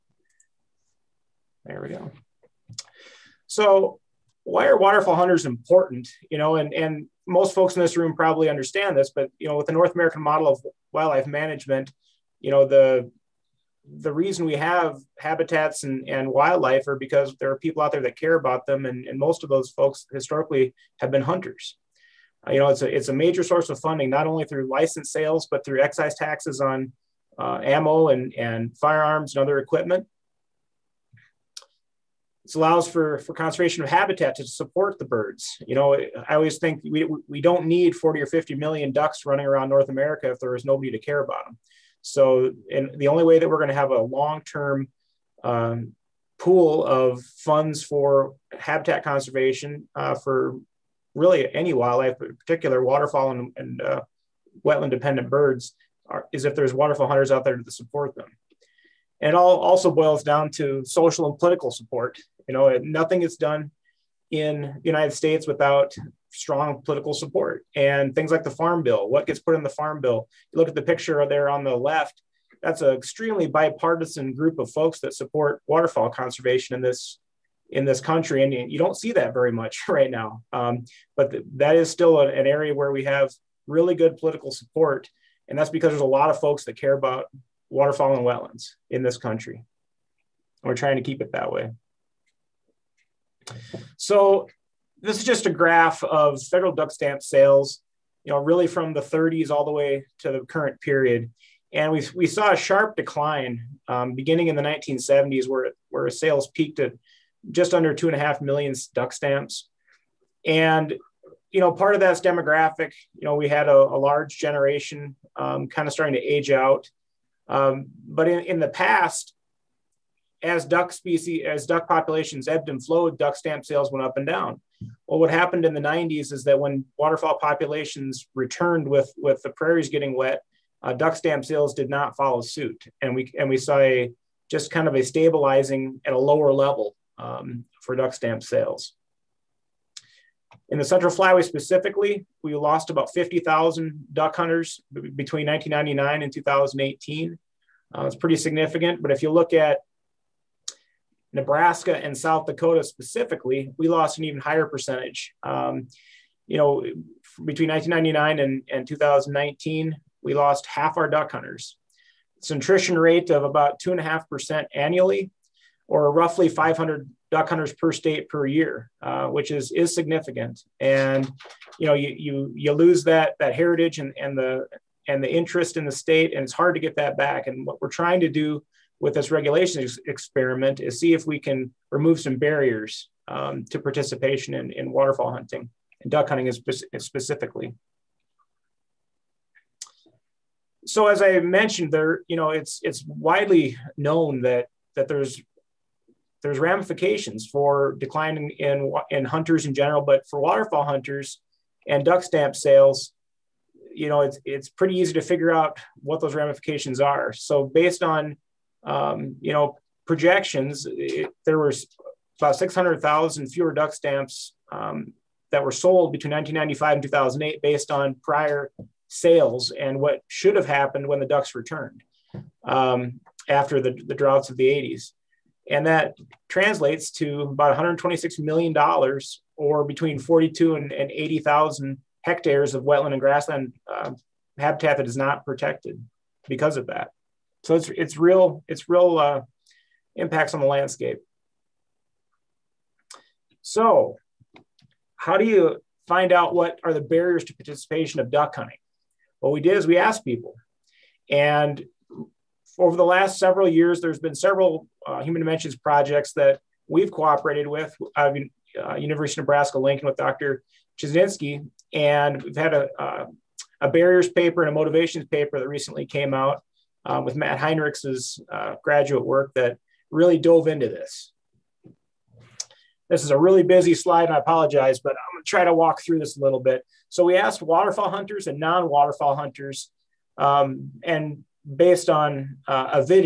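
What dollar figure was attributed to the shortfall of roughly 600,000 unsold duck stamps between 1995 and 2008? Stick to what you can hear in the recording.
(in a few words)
$126 million.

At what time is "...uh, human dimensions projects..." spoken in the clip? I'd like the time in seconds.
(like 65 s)
255 s.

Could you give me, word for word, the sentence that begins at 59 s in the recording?
And it all also boils down to social and political support.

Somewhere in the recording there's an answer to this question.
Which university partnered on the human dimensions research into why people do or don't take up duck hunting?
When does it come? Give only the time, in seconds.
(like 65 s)
258 s.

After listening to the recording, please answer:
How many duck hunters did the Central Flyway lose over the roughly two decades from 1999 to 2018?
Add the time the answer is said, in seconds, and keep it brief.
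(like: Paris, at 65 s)
about 50,000, at 142 s.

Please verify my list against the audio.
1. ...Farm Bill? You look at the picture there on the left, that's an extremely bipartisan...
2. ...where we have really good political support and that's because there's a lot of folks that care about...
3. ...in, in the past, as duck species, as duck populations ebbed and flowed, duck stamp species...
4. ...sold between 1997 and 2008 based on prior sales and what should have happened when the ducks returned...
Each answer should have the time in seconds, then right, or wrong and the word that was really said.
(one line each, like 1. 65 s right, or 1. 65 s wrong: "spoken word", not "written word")
1. 69 s right
2. 82 s right
3. 118 s wrong: "sales", not "species"
4. 215 s wrong: "1995", not "1997".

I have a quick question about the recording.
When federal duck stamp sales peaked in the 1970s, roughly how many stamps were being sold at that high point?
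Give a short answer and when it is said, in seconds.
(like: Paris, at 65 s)
just under 2.5 million, at 107 s.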